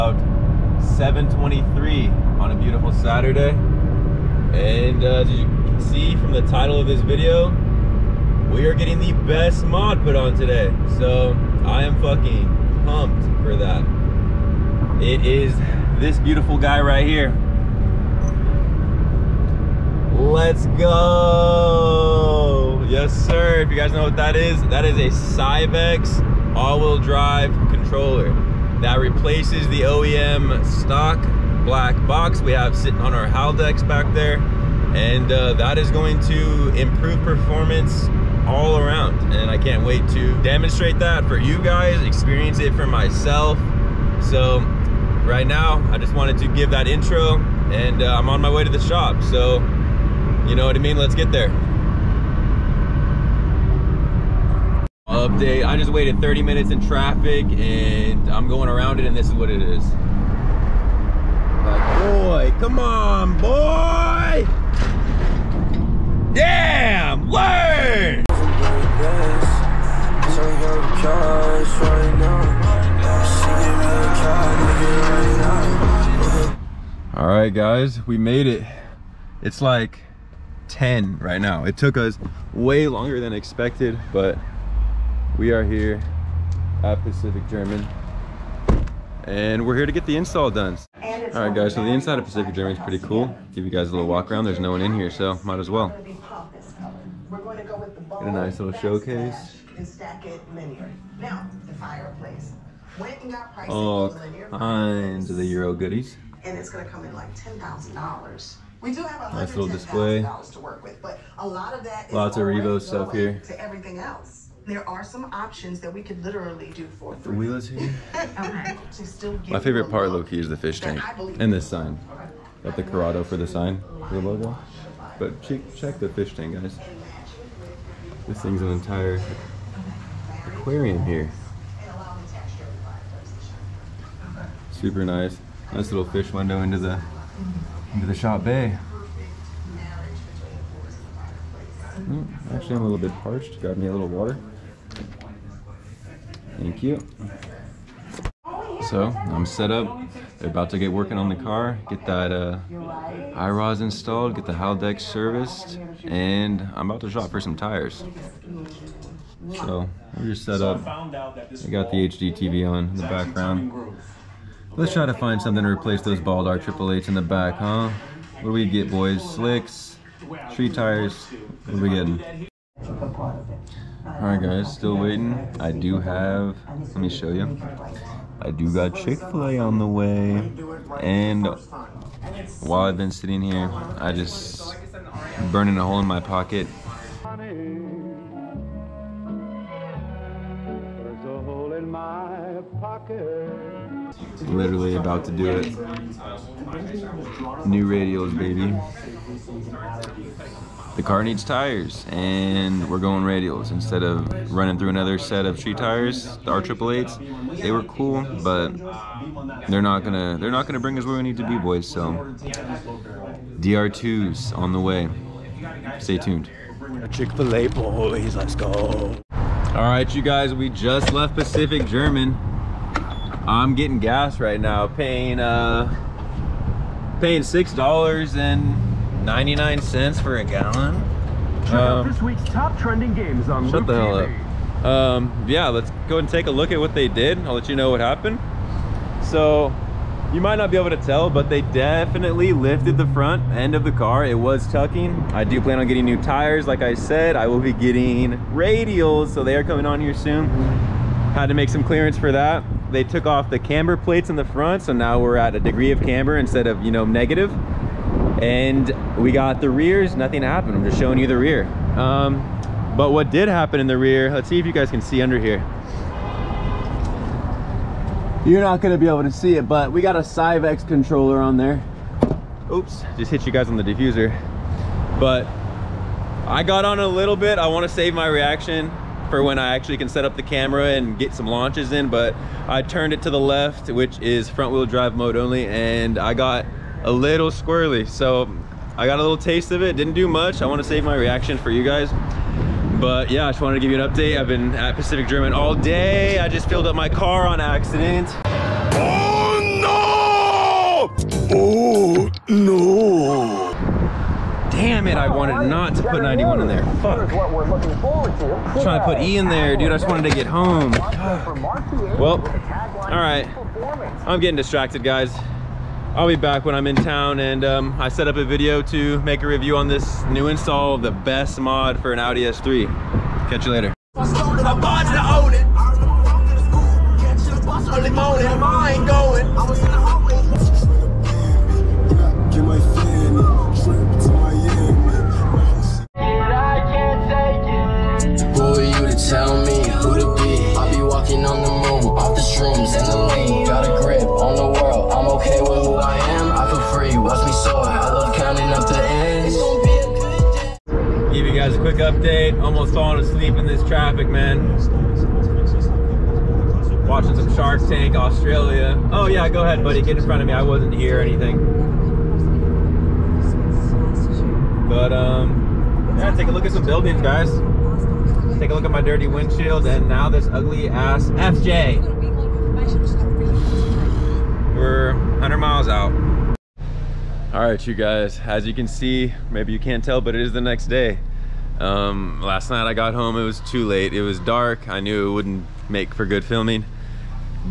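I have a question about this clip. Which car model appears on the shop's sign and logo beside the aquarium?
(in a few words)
Corrado.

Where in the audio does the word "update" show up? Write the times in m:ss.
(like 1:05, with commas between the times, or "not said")
0:55, 4:54, 5:52.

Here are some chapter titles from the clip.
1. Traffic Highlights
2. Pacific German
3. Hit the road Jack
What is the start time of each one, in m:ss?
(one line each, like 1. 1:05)
1. 0:54
2. 1:18
3. 3:36.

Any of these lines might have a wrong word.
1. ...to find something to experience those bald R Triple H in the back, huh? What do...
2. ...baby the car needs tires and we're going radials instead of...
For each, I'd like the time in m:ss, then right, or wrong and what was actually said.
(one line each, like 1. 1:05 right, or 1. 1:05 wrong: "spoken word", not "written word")
1. 2:45 wrong: "replace", not "experience"
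2. 3:18 right.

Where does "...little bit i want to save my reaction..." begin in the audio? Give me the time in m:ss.
4:37.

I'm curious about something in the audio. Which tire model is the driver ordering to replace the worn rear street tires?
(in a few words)
DR2s.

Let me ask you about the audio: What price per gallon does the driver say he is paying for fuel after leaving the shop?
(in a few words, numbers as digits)
$6.99.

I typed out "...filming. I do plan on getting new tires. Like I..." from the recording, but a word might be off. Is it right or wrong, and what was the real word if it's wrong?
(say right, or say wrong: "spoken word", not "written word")
wrong: "tucking", not "filming".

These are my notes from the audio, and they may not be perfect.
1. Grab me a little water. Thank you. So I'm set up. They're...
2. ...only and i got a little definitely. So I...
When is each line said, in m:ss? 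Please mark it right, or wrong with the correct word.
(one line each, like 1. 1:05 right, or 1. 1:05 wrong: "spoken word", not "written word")
1. 2:23 right
2. 4:45 wrong: "squirrely", not "definitely".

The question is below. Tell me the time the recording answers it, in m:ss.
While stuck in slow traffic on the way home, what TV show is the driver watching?
5:57.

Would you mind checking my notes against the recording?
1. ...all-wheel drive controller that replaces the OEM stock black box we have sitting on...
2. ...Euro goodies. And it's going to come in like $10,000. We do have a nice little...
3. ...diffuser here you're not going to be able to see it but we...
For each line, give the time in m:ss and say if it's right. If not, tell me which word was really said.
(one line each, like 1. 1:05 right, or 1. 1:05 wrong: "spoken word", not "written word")
1. 0:26 right
2. 1:45 right
3. 4:25 wrong: "under", not "diffuser".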